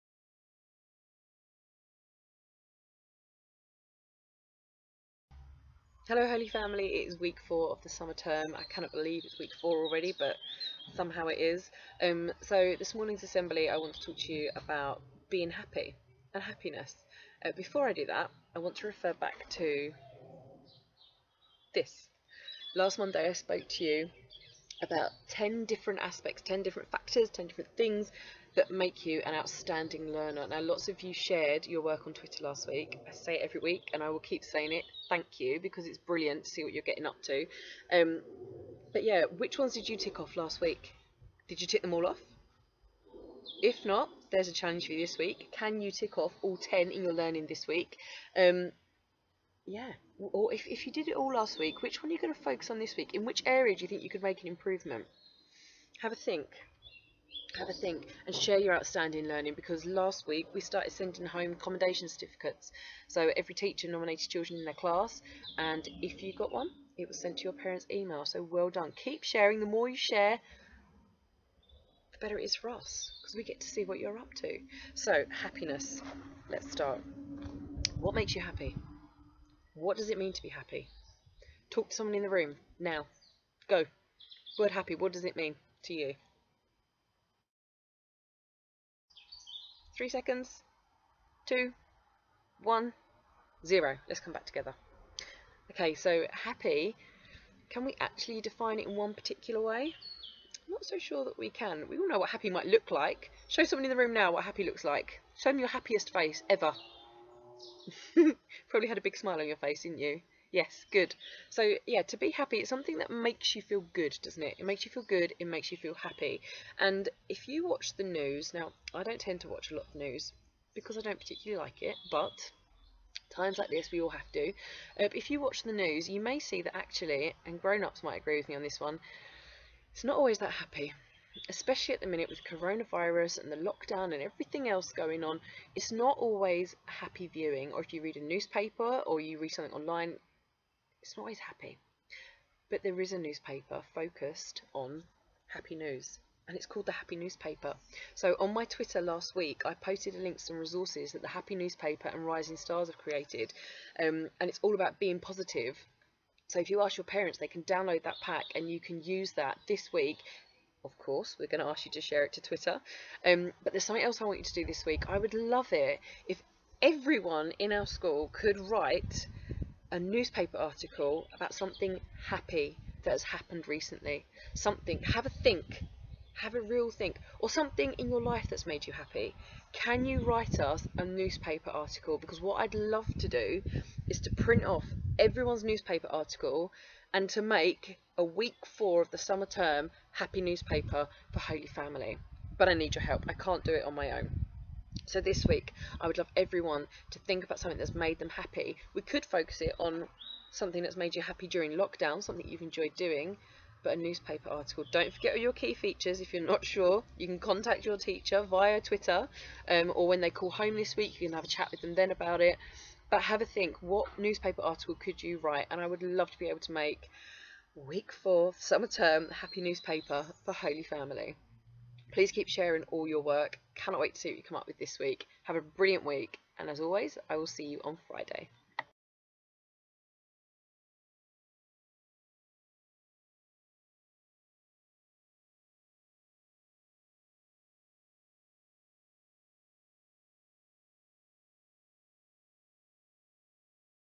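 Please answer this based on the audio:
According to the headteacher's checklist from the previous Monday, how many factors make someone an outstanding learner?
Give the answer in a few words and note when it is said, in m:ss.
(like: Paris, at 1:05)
10, at 0:25.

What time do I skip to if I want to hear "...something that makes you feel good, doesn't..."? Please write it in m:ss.
1:52.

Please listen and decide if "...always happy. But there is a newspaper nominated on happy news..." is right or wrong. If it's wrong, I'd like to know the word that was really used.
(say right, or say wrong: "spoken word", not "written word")
wrong: "focused", not "nominated".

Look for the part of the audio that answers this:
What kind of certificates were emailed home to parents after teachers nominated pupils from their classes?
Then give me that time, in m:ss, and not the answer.
1:01.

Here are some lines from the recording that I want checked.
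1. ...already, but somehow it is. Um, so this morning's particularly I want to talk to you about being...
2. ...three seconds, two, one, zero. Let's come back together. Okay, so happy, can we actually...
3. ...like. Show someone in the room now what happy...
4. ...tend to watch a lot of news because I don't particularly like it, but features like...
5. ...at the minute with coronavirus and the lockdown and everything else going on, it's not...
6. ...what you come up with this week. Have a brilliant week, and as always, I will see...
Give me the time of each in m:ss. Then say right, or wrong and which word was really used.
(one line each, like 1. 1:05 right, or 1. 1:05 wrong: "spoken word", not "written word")
1. 0:09 wrong: "assembly", not "particularly"
2. 1:30 right
3. 1:42 right
4. 1:59 wrong: "times", not "features"
5. 2:11 right
6. 3:44 right.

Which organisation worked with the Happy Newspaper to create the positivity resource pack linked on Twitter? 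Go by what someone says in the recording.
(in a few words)
Rising Stars.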